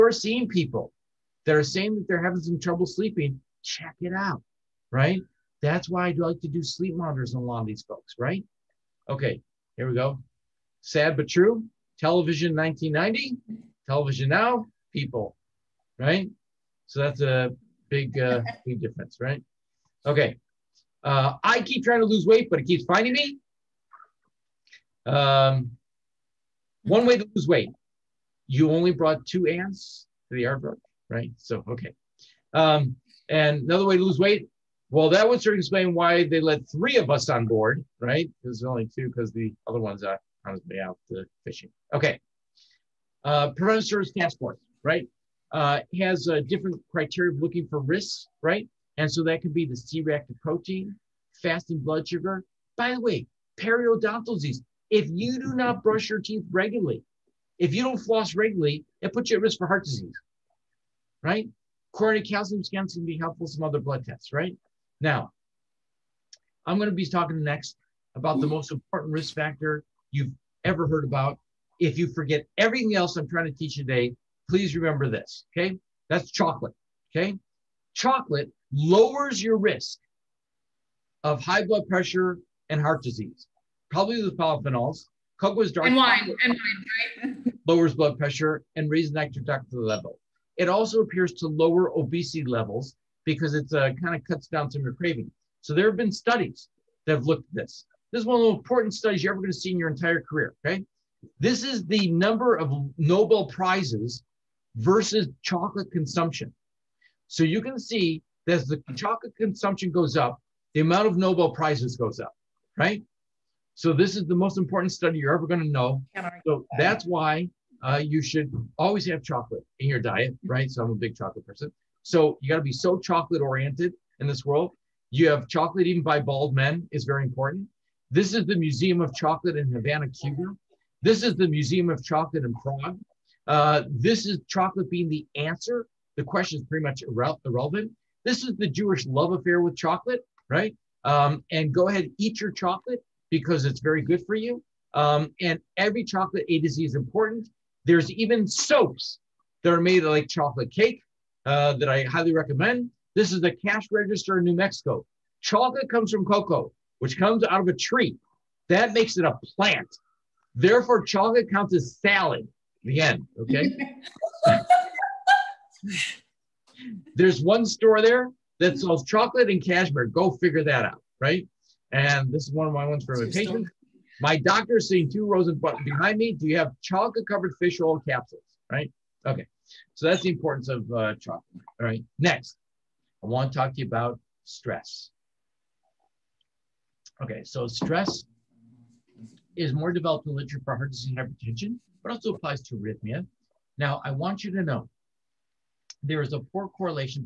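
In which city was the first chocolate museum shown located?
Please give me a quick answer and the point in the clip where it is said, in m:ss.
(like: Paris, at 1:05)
Havana, at 2:09.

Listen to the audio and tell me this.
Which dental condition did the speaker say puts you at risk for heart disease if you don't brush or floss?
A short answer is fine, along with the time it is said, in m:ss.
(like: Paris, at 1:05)
periodontal disease, at 0:53.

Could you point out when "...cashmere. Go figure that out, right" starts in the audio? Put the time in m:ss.
2:49.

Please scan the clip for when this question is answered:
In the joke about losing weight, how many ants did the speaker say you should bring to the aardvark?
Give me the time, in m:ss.
0:29.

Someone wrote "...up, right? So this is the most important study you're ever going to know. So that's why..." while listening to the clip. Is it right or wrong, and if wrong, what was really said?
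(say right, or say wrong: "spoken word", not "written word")
right.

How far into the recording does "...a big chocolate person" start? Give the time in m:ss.
2:00.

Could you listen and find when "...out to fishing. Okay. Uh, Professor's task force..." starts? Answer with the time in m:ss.
0:40.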